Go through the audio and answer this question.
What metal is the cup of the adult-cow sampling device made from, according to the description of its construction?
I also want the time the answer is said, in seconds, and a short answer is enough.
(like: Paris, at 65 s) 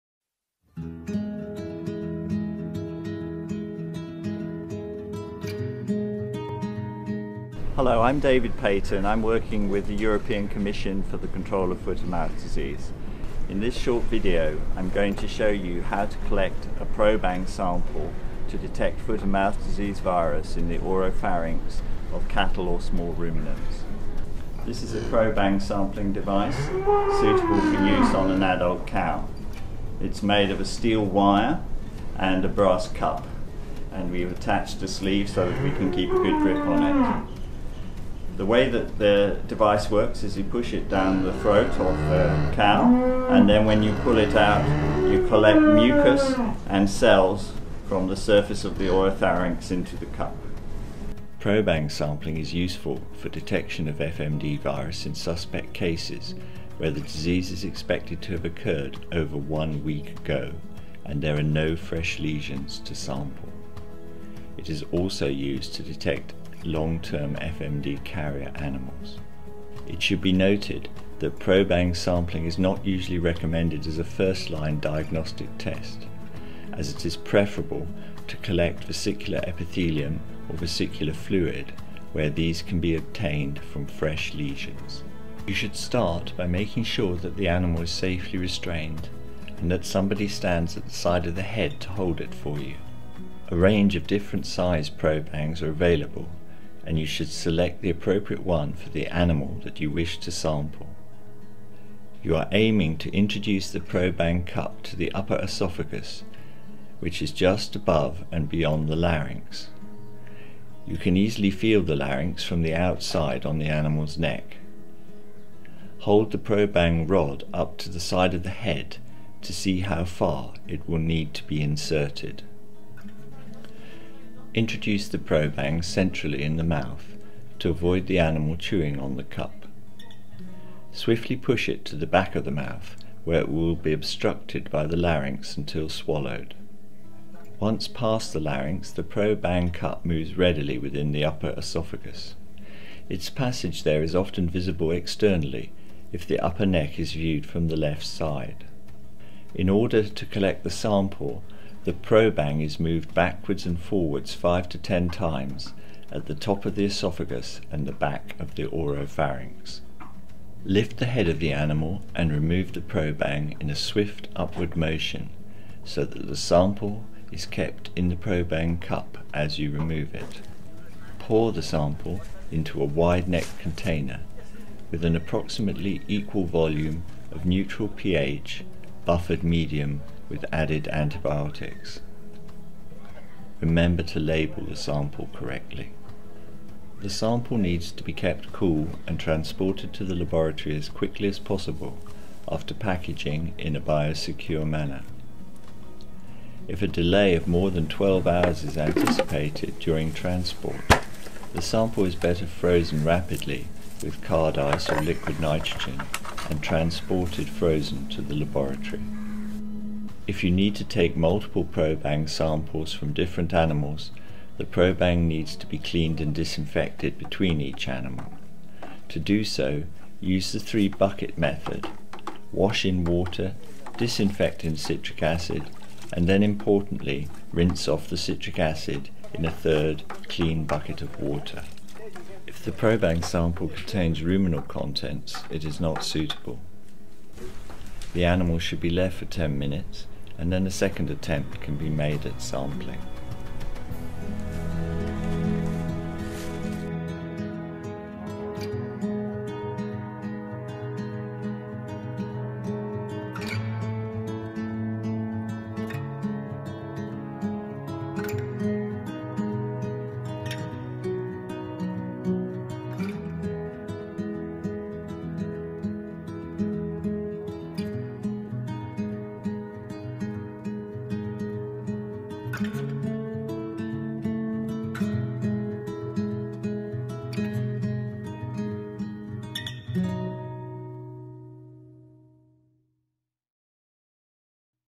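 Brass, at 32 s.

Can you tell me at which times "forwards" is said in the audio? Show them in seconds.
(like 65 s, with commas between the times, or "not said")
153 s.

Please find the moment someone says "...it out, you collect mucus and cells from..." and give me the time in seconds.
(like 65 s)
44 s.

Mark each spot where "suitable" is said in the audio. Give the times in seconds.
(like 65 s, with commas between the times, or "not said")
26 s, 236 s.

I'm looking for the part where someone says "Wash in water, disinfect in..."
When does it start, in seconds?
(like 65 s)
222 s.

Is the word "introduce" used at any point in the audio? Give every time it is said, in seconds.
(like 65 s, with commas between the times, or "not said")
103 s, 124 s.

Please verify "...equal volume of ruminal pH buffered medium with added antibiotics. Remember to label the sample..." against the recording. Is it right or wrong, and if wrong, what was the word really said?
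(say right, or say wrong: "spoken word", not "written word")
wrong: "neutral", not "ruminal".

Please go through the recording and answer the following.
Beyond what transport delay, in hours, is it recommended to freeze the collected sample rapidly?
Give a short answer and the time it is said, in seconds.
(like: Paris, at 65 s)
12 hours, at 197 s.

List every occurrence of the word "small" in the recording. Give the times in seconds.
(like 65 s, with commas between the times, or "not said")
22 s.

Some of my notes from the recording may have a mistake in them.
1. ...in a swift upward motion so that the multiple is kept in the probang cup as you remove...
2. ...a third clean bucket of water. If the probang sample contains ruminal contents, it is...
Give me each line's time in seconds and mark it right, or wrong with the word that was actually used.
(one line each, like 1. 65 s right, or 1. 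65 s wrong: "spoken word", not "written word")
1. 163 s wrong: "sample", not "multiple"
2. 229 s right.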